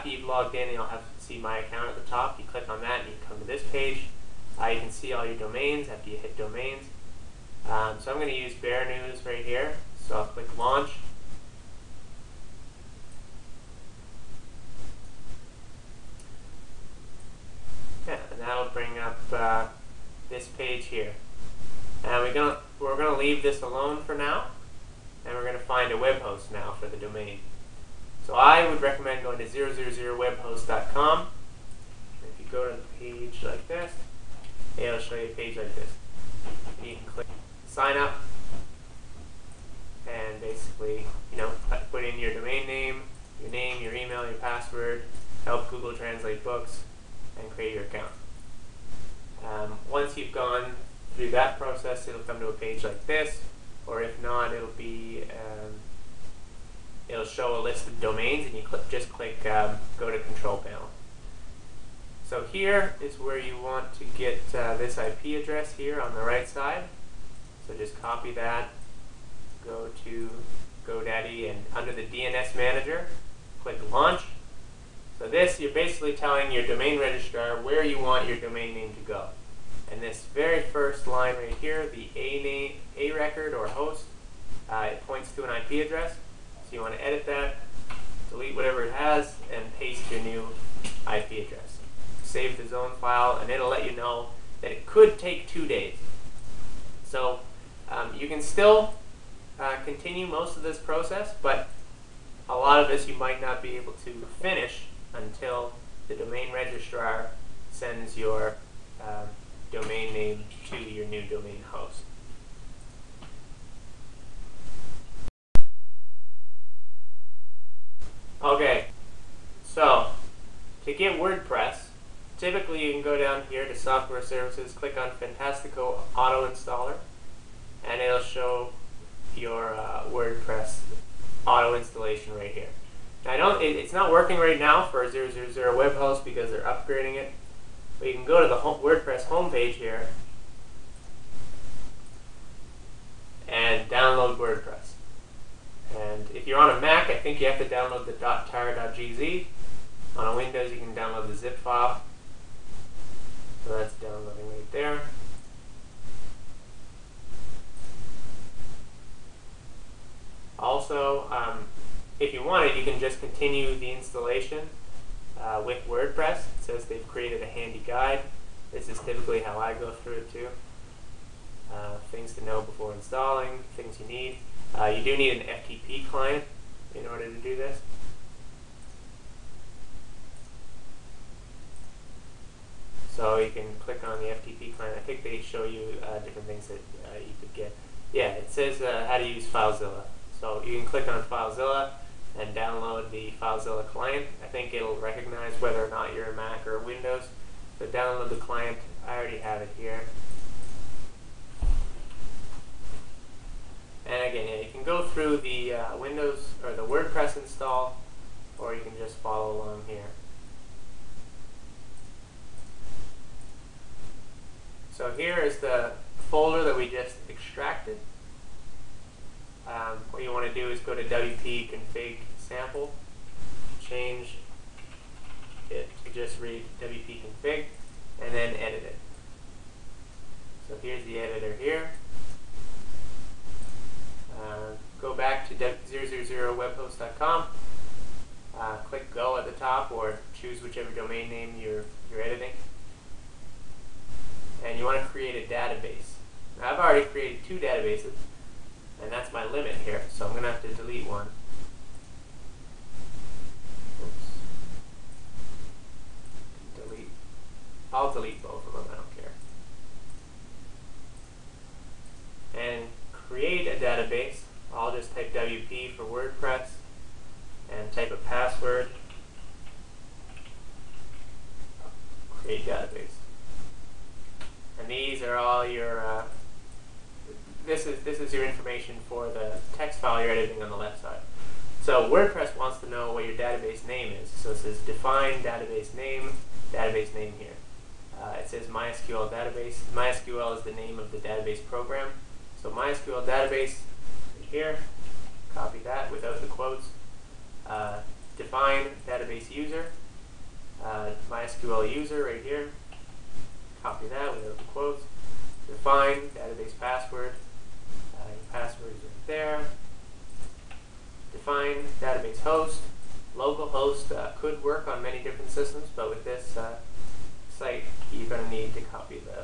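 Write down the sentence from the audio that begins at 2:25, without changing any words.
And if you're on a Mac, I think you have to download the .tar.gz.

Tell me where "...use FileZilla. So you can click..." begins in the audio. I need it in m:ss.
3:09.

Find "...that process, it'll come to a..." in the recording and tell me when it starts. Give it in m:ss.
0:51.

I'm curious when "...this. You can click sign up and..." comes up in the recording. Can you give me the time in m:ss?
0:35.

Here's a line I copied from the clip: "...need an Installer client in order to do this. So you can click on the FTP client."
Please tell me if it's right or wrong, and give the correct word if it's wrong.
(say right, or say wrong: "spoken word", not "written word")
wrong: "FTP", not "Installer".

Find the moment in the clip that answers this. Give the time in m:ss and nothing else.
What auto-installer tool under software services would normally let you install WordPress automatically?
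2:05.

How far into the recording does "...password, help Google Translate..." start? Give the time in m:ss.
0:44.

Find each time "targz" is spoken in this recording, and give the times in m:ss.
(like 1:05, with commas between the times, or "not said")
2:28.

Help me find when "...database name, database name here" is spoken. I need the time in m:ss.
4:45.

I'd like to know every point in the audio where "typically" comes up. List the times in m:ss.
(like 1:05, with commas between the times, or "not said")
2:02, 2:48.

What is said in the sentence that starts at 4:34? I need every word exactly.
And these are all your, uh, this, is, this is your information for the text file you're editing on the left side.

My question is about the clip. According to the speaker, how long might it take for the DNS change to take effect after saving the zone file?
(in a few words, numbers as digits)
2 days.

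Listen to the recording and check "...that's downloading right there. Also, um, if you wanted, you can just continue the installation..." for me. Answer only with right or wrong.
right.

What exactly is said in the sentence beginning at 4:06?
Now I've already created two databases, and that's my limit here, so I'm going to have to delete one.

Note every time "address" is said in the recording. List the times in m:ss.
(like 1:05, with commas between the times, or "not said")
1:05, 1:25, 1:31.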